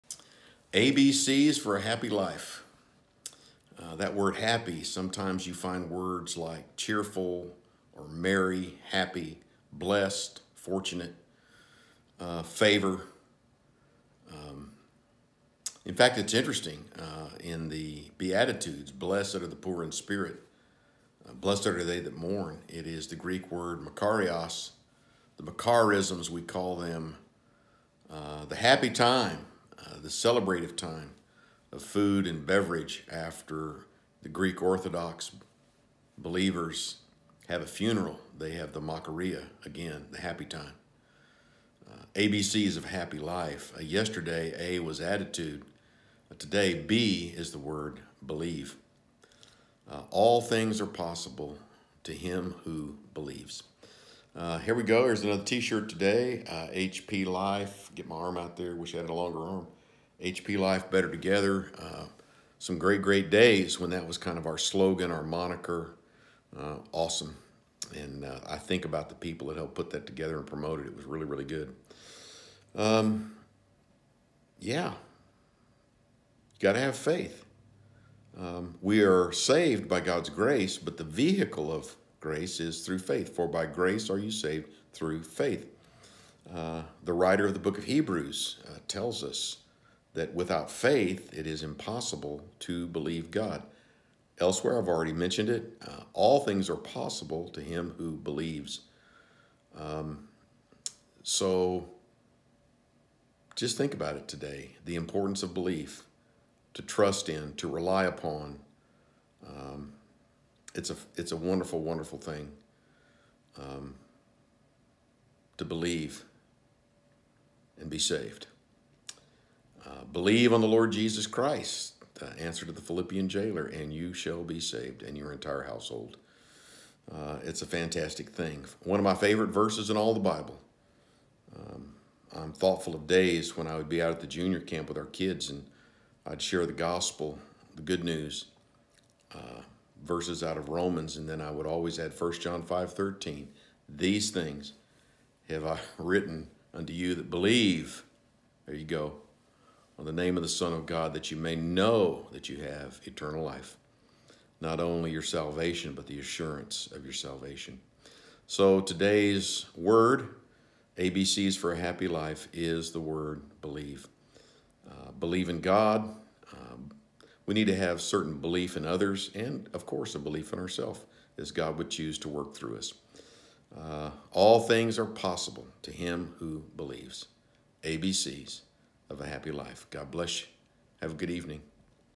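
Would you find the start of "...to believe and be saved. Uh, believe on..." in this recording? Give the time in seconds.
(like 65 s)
115 s.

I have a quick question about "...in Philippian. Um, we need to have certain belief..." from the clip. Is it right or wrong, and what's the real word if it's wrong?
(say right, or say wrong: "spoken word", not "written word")
wrong: "God", not "Philippian".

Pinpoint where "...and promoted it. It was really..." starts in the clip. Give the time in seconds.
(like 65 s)
70 s.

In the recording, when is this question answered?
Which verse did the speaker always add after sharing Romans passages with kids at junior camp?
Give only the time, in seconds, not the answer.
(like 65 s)
142 s.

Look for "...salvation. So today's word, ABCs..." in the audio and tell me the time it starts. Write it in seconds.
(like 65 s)
157 s.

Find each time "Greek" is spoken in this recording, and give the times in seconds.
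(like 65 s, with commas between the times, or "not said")
23 s, 34 s.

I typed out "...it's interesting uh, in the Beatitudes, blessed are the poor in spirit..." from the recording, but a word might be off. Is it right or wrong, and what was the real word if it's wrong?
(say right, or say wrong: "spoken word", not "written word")
right.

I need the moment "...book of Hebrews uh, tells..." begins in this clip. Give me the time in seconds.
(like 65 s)
87 s.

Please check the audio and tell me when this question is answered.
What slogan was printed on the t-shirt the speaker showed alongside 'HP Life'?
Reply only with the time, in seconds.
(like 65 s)
60 s.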